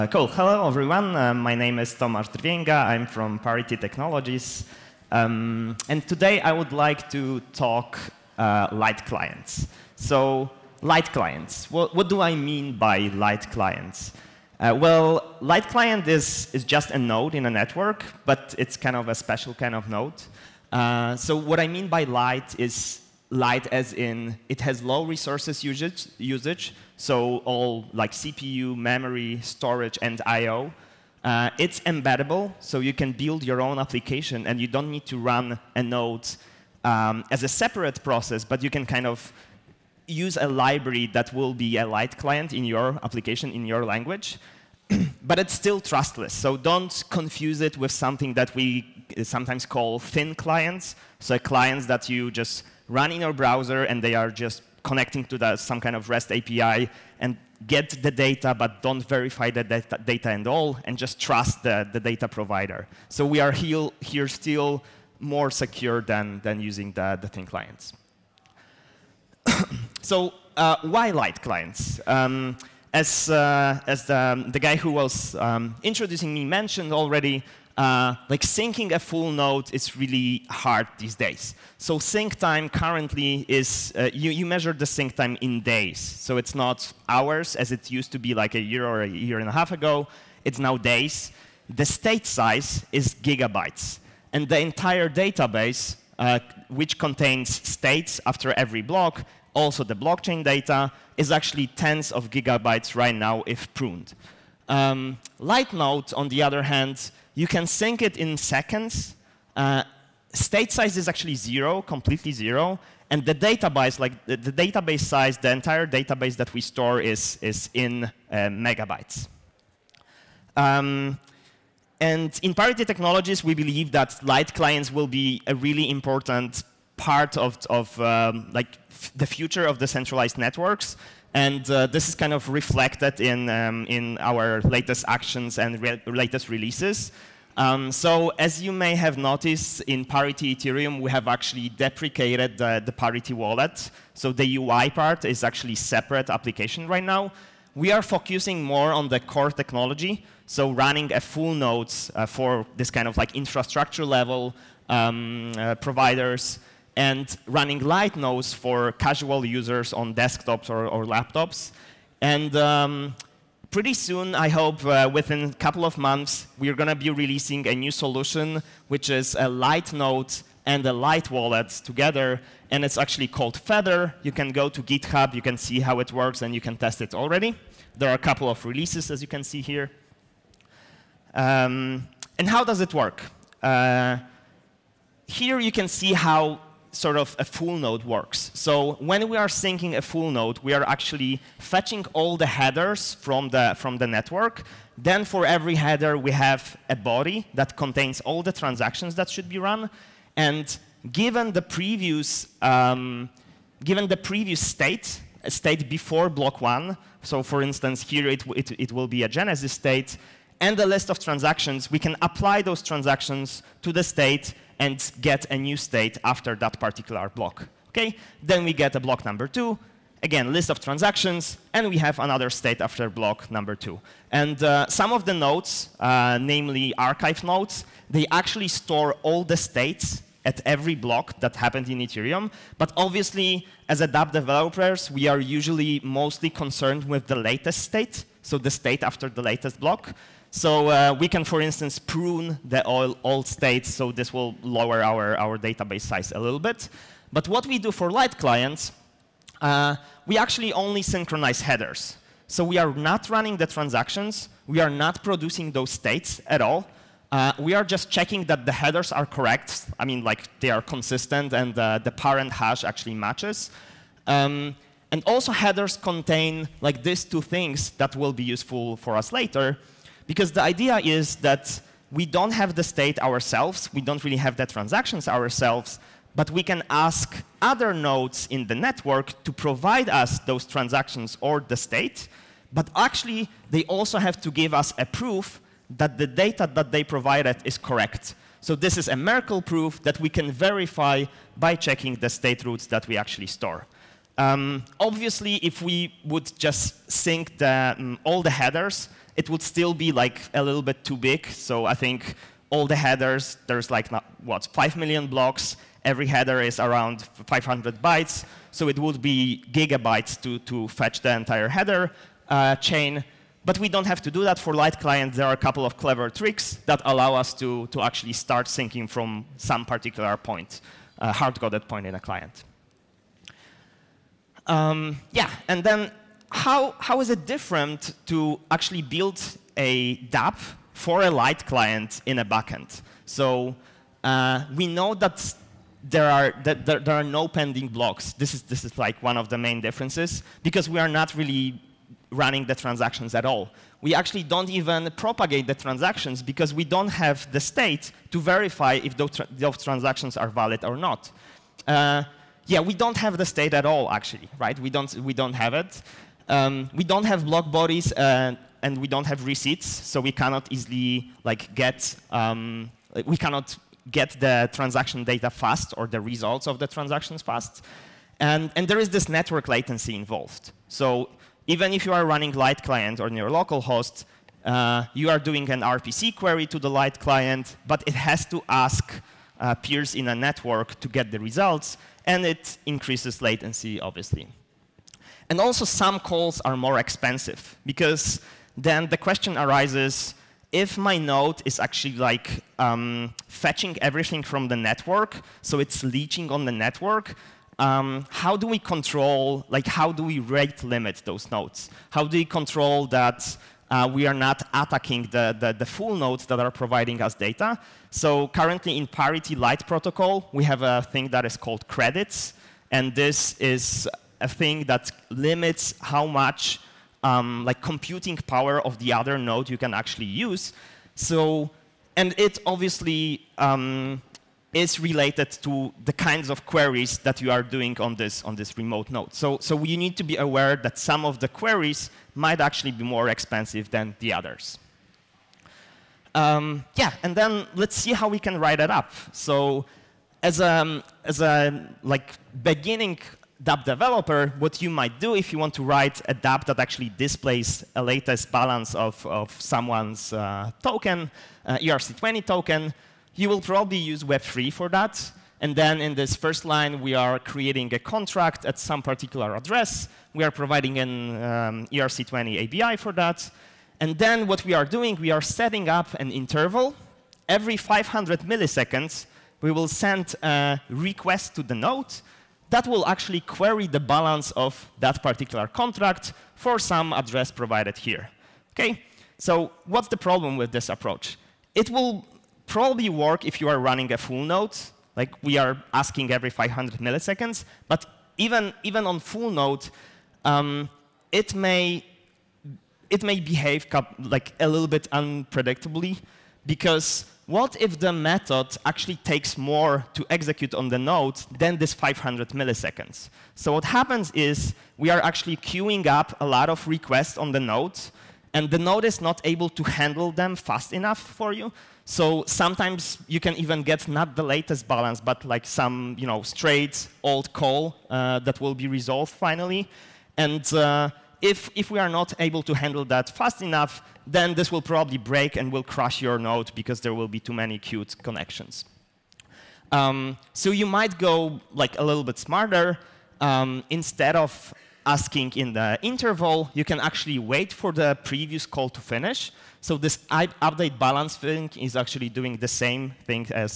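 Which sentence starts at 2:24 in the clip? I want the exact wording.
So the UI part is actually separate application right now.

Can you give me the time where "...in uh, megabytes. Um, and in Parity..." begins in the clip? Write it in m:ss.
1:57.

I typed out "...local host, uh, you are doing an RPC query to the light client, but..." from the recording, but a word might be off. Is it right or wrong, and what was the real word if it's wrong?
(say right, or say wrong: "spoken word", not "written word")
right.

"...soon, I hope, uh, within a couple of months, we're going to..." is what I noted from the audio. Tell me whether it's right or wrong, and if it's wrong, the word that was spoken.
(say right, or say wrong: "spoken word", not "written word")
right.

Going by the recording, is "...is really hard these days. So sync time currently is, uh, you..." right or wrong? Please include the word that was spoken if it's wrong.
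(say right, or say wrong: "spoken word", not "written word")
right.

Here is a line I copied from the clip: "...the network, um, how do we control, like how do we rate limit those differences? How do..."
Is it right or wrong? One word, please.
wrong.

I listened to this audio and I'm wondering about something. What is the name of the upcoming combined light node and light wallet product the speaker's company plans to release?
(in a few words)
Feather.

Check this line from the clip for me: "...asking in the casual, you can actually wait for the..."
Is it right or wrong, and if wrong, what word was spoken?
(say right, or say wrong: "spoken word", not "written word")
wrong: "interval", not "casual".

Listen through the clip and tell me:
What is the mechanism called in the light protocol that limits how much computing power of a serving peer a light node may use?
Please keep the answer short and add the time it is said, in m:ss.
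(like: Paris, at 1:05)
Credits, at 6:51.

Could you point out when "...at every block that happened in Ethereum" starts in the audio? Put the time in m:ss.
3:50.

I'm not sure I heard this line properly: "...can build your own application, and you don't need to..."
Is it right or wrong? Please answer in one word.
right.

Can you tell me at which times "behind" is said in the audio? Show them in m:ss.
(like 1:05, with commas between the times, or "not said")
not said.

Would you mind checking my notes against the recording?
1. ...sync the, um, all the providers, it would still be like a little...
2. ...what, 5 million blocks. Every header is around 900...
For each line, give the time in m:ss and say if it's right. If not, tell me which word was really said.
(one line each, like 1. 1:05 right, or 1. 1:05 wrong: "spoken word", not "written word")
1. 4:57 wrong: "headers", not "providers"
2. 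5:04 wrong: "500", not "900".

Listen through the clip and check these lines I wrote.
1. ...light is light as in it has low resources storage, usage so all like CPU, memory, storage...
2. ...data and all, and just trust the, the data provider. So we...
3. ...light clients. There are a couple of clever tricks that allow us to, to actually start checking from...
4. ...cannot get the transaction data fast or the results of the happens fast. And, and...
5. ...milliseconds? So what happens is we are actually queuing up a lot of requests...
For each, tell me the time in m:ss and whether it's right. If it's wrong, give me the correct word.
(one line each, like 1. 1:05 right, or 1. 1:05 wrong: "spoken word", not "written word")
1. 0:22 wrong: "usage", not "storage"
2. 1:00 right
3. 5:14 wrong: "syncing", not "checking"
4. 6:03 wrong: "transactions", not "happens"
5. 8:22 right.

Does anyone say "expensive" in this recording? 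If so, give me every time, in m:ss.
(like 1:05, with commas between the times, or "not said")
6:26, 7:13.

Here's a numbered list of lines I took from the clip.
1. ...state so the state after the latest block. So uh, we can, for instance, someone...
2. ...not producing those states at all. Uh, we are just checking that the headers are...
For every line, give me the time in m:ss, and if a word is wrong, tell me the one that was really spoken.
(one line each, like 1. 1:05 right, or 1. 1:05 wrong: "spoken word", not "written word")
1. 3:57 wrong: "prune", not "someone"
2. 4:14 right.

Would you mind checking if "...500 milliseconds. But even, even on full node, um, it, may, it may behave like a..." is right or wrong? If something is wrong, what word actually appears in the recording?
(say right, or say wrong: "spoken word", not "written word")
right.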